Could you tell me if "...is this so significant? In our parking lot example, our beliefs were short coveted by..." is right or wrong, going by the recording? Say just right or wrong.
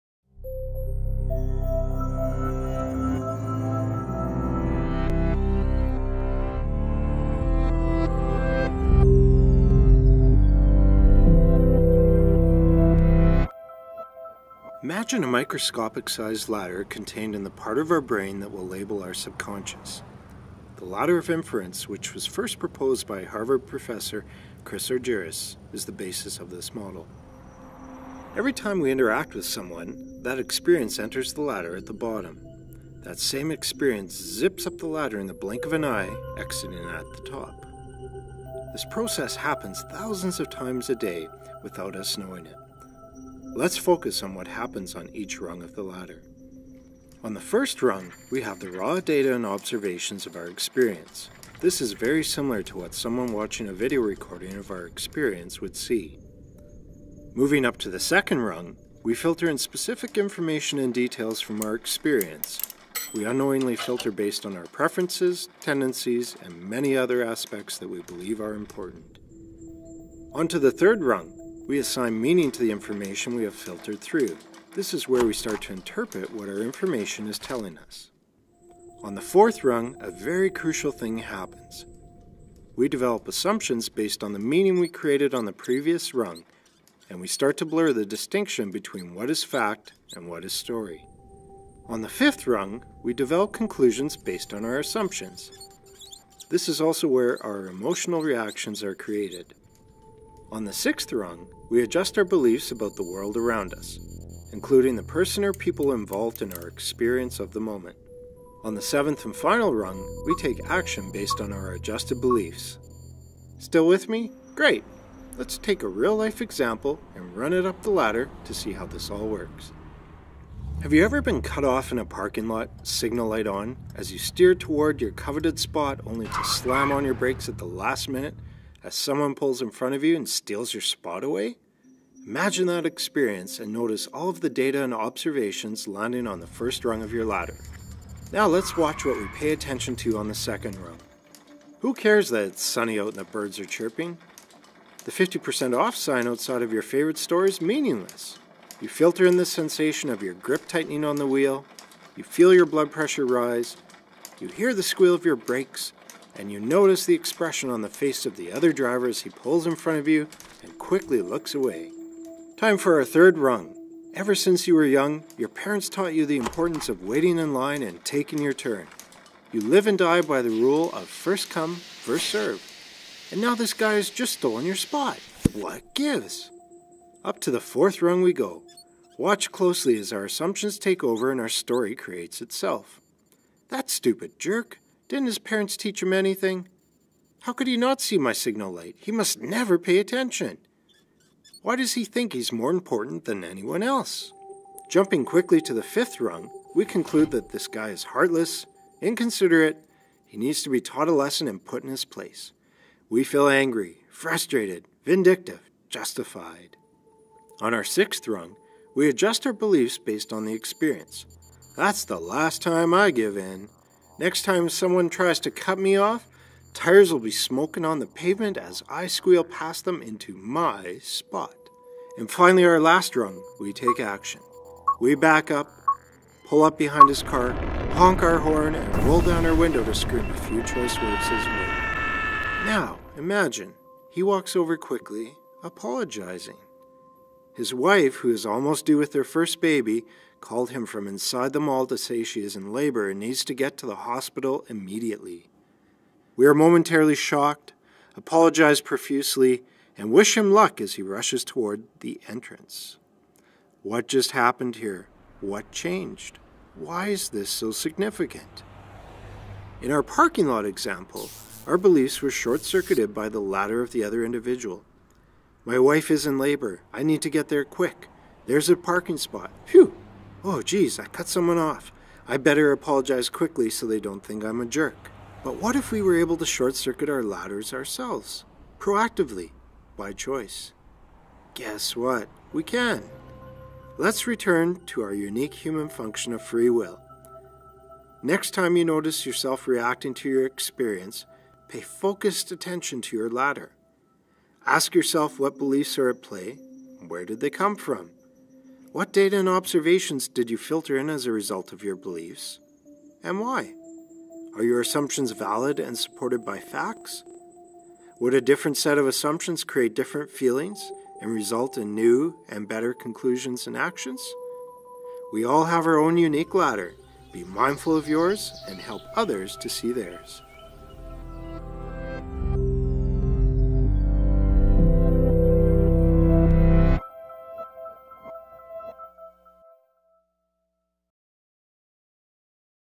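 wrong.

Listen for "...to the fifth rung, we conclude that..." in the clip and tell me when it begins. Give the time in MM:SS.
03:15.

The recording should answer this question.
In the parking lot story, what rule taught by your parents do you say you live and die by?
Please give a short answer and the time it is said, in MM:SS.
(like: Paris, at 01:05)
first come, first serve, at 02:51.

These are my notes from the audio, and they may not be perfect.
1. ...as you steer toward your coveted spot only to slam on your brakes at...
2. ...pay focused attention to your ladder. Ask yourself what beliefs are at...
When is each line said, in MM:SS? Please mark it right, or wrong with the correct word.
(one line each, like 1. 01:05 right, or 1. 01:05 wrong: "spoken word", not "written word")
1. 02:03 right
2. 04:51 right.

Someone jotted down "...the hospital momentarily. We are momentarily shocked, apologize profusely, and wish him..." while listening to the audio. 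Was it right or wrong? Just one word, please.
wrong.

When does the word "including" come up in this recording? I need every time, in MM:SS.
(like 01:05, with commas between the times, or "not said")
01:44.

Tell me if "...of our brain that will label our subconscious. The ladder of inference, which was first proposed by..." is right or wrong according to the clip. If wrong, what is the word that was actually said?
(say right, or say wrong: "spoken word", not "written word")
right.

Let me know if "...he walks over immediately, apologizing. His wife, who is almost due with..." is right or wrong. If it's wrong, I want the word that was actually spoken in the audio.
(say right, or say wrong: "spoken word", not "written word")
wrong: "quickly", not "immediately".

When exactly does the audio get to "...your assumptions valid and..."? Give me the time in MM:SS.
05:04.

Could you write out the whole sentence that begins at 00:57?
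Moving up to the second rung, we filter in specific information and details from our experience.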